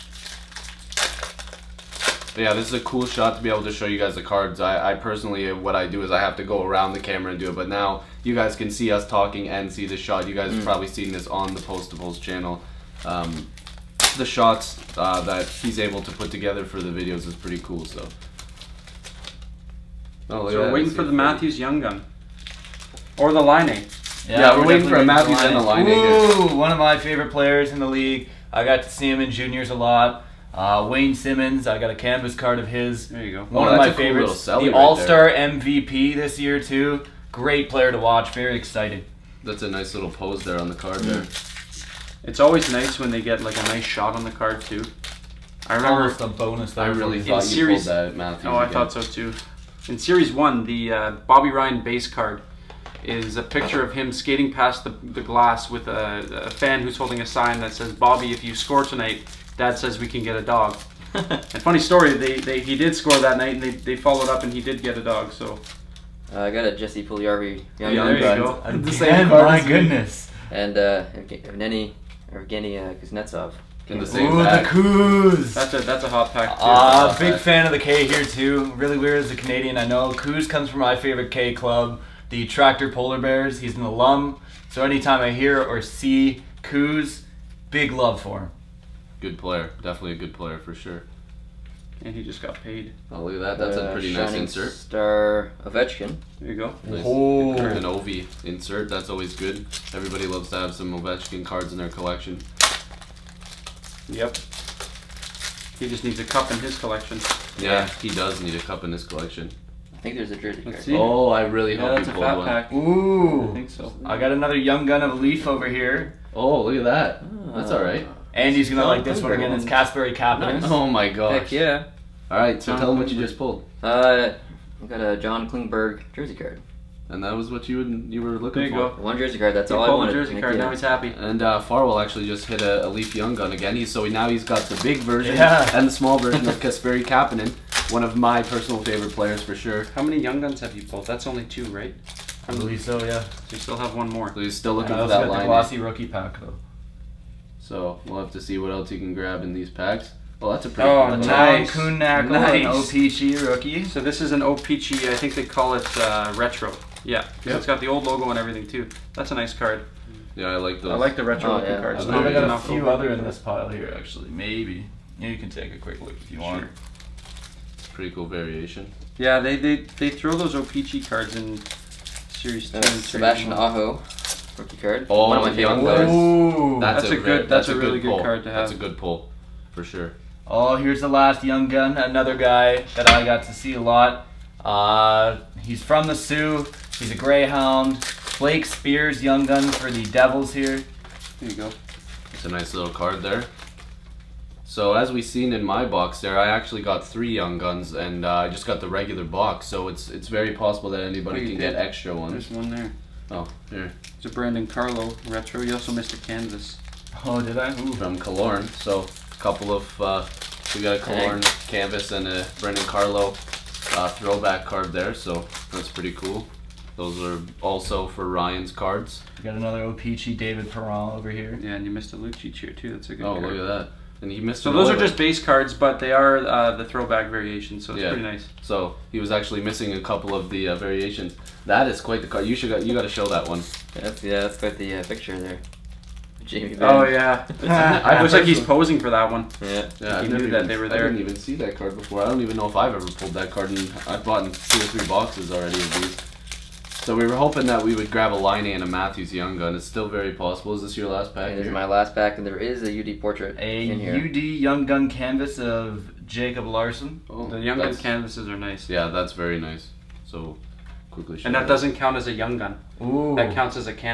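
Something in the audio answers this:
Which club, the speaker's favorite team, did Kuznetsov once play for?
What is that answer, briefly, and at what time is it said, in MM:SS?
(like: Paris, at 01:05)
Tractor Polar Bears, at 01:22.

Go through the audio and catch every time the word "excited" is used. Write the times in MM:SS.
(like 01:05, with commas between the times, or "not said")
00:38.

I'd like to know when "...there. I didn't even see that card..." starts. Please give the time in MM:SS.
04:00.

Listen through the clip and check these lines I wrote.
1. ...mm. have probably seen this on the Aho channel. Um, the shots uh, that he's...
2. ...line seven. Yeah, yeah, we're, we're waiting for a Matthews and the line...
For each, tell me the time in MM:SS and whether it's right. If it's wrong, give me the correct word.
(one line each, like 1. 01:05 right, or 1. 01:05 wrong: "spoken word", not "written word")
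1. 00:10 wrong: "Postables", not "Aho"
2. 00:23 wrong: "eight", not "seven".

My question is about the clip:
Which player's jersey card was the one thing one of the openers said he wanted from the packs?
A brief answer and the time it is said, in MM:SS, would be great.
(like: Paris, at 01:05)
John Klingberg, at 02:05.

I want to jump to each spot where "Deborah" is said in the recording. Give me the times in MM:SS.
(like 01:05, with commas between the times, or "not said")
not said.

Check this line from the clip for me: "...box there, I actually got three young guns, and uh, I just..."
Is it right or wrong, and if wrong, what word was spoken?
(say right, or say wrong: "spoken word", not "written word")
right.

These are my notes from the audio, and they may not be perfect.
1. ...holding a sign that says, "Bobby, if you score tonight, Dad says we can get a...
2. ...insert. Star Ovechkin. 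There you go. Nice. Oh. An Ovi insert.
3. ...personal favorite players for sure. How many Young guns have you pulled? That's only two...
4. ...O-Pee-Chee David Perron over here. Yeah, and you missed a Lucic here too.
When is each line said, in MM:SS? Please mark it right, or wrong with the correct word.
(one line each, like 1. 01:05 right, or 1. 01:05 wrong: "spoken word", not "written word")
1. 00:56 right
2. 01:34 right
3. 02:18 right
4. 03:39 right.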